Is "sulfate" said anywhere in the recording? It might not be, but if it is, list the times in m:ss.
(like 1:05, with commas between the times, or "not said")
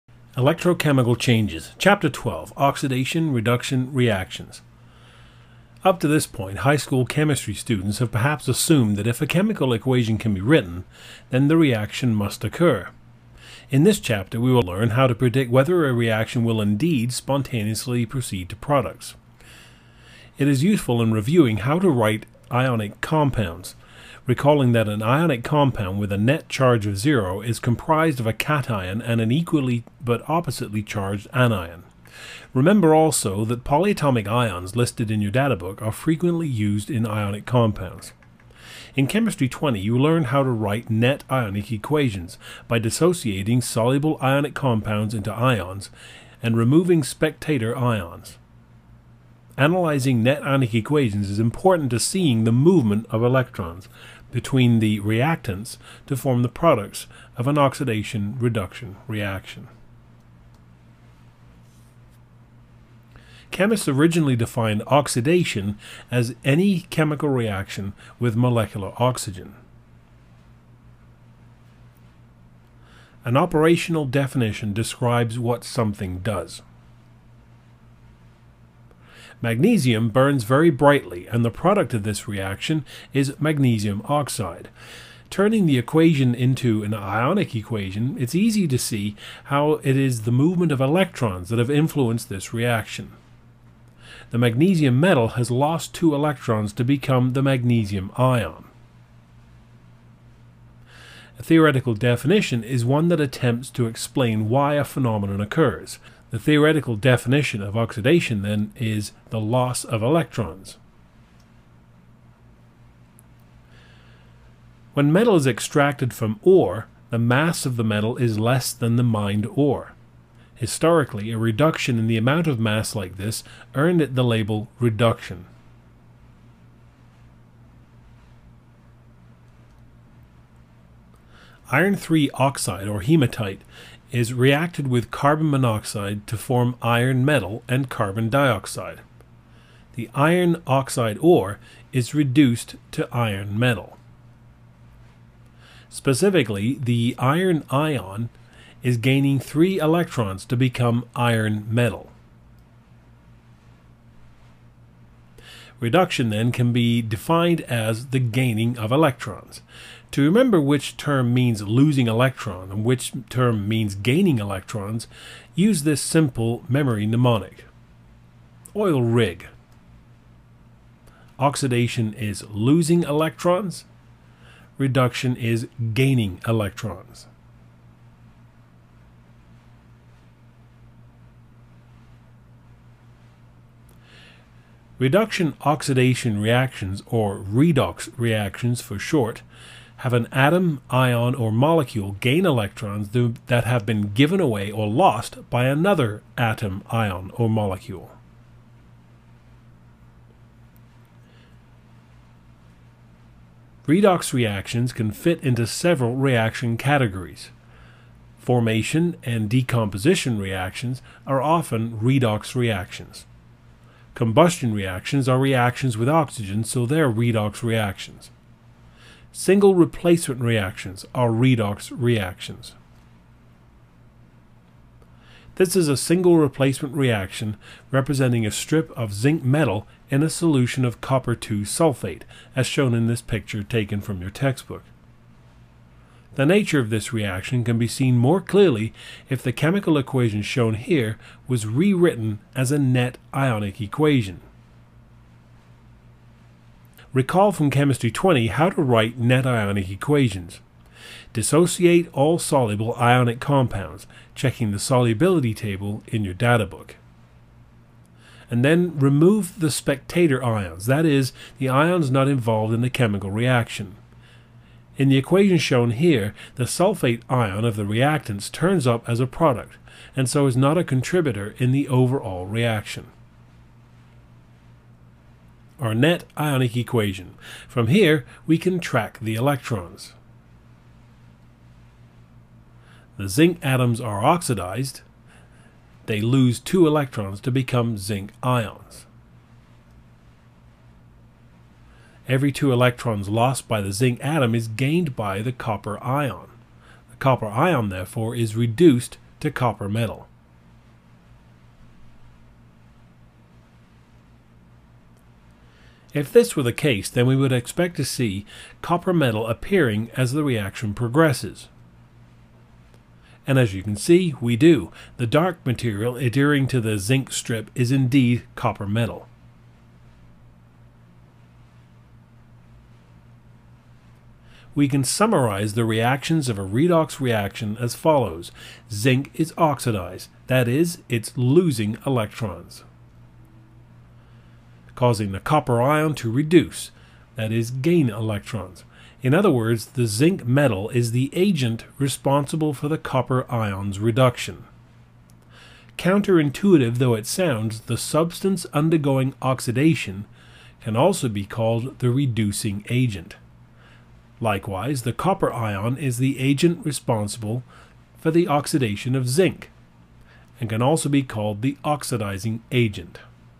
3:51, 4:26.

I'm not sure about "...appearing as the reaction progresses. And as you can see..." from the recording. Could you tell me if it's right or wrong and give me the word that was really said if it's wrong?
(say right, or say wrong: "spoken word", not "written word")
right.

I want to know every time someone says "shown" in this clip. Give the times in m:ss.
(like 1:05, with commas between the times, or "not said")
3:52, 4:00, 4:25.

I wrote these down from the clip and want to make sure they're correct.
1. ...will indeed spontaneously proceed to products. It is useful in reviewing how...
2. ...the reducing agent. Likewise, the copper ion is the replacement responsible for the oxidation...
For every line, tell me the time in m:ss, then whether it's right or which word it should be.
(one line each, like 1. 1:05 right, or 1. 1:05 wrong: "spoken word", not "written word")
1. 0:16 right
2. 5:51 wrong: "agent", not "replacement".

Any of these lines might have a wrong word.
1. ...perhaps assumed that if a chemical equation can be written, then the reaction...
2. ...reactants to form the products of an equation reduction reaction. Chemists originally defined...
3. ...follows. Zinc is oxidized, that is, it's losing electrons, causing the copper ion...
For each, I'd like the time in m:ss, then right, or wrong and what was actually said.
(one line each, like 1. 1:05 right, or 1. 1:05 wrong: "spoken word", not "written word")
1. 0:08 right
2. 0:55 wrong: "oxidation", not "equation"
3. 5:27 right.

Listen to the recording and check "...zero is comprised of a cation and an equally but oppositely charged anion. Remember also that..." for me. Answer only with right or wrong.
right.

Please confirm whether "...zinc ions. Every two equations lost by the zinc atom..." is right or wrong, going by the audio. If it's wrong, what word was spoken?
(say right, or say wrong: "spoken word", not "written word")
wrong: "electrons", not "equations".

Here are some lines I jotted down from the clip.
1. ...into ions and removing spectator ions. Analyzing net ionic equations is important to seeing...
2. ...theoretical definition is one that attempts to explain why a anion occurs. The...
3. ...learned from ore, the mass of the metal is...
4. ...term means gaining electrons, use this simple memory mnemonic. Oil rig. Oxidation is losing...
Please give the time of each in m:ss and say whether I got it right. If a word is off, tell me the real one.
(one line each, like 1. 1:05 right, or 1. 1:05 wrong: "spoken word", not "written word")
1. 0:45 right
2. 1:41 wrong: "phenomenon", not "anion"
3. 1:55 wrong: "extracted", not "learned"
4. 2:43 right.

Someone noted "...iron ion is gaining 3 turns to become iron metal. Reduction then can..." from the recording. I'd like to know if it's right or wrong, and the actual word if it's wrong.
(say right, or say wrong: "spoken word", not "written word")
wrong: "electrons", not "turns".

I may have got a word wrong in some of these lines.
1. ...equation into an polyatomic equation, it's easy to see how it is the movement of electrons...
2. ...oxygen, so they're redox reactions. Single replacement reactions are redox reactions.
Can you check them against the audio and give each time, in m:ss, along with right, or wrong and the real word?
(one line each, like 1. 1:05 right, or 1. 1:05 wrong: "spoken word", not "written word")
1. 1:25 wrong: "ionic", not "polyatomic"
2. 3:36 right.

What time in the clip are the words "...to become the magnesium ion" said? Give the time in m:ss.
1:36.